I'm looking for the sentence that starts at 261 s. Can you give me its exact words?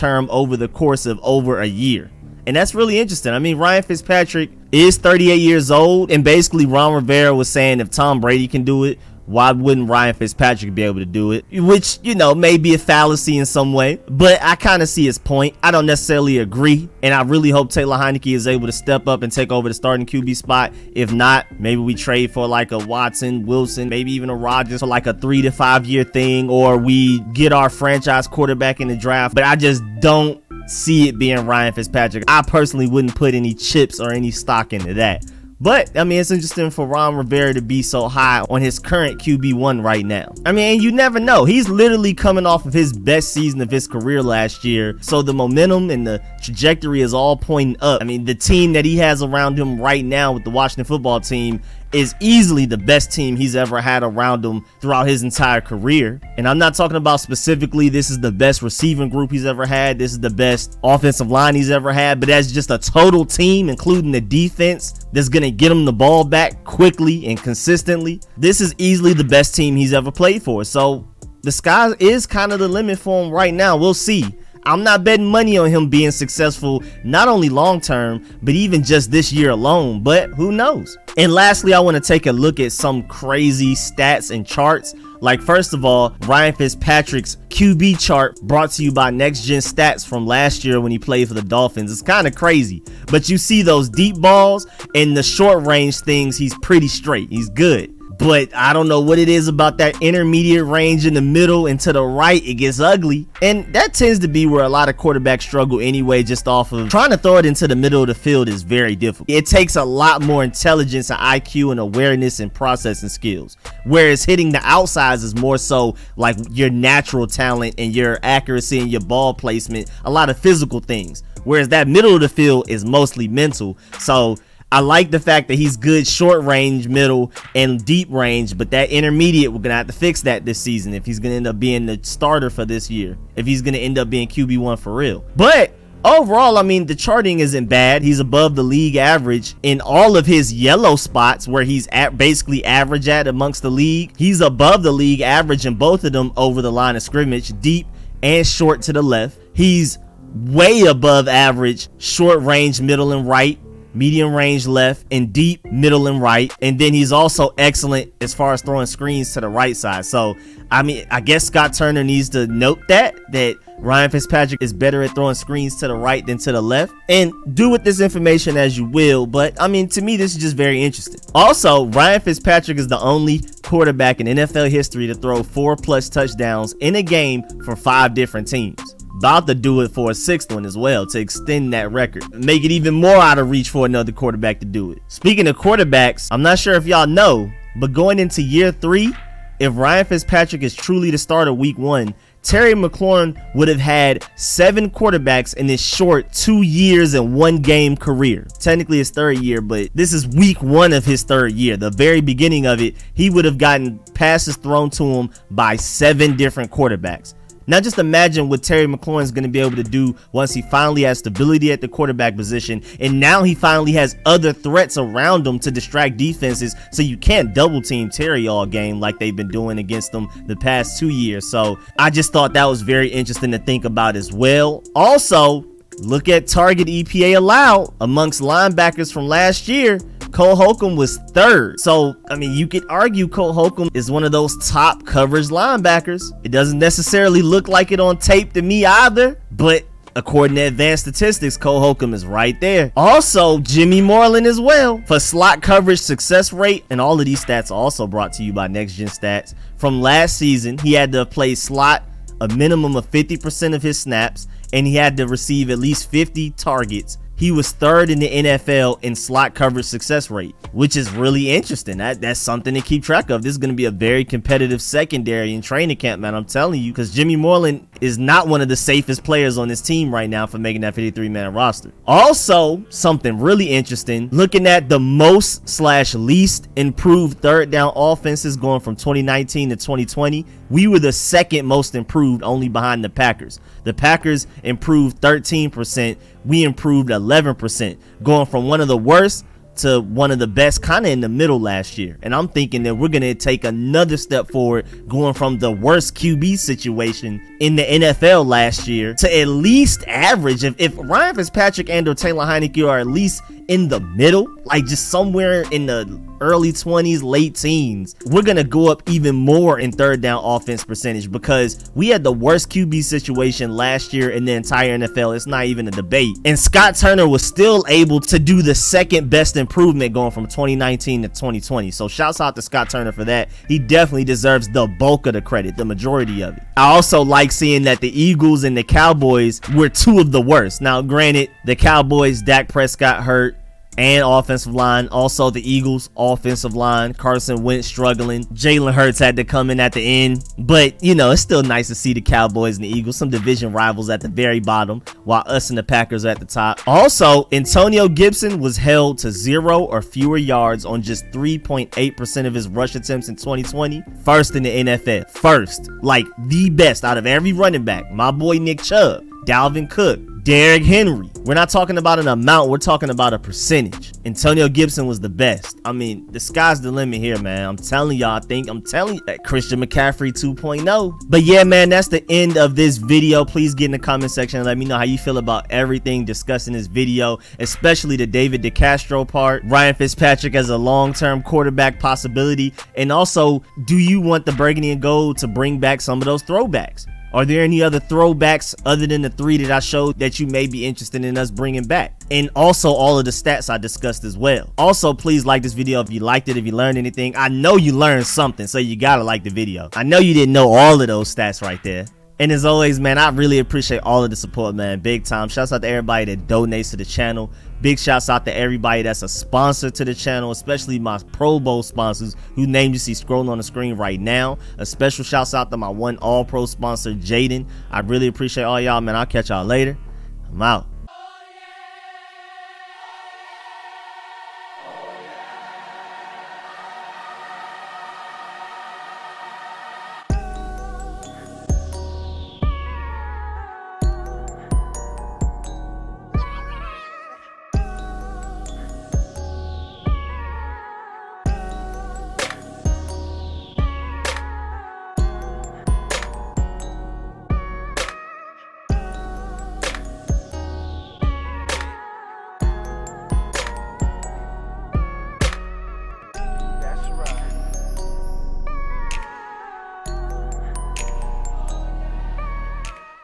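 That, that's something to keep track of.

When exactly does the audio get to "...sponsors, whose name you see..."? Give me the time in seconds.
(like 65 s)
411 s.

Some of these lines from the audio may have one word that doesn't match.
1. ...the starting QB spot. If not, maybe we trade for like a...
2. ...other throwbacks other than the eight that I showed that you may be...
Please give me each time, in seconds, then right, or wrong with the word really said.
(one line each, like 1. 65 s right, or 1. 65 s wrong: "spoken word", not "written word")
1. 19 s right
2. 387 s wrong: "three", not "eight".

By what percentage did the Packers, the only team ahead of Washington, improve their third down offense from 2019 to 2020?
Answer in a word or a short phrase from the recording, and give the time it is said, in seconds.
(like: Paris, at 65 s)
13%, at 285 s.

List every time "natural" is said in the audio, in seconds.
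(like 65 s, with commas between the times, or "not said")
116 s.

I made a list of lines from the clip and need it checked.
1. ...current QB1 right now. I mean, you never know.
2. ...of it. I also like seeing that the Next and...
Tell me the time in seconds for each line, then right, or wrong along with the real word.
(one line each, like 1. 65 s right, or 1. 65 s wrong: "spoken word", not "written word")
1. 38 s right
2. 326 s wrong: "Eagles", not "Next".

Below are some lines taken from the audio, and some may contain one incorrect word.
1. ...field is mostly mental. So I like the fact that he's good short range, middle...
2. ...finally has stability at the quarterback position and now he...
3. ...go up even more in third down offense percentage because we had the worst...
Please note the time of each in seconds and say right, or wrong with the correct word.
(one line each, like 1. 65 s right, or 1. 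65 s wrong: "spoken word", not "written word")
1. 122 s right
2. 210 s right
3. 308 s right.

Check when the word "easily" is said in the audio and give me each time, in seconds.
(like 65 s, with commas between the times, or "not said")
52 s, 68 s.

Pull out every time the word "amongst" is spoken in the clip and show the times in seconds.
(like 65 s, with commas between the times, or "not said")
143 s, 228 s.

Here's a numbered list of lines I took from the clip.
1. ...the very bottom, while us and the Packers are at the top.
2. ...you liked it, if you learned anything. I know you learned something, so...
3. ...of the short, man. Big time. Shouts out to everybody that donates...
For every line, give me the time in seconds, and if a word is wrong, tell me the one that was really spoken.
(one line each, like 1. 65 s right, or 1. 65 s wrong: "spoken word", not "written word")
1. 344 s right
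2. 396 s right
3. 404 s wrong: "support", not "short".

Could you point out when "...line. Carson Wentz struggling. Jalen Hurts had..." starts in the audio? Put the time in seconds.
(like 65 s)
336 s.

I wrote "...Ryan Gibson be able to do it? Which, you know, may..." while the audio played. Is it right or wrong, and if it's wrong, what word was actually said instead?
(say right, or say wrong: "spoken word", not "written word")
wrong: "Fitzpatrick", not "Gibson".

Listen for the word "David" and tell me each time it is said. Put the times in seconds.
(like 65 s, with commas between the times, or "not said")
378 s.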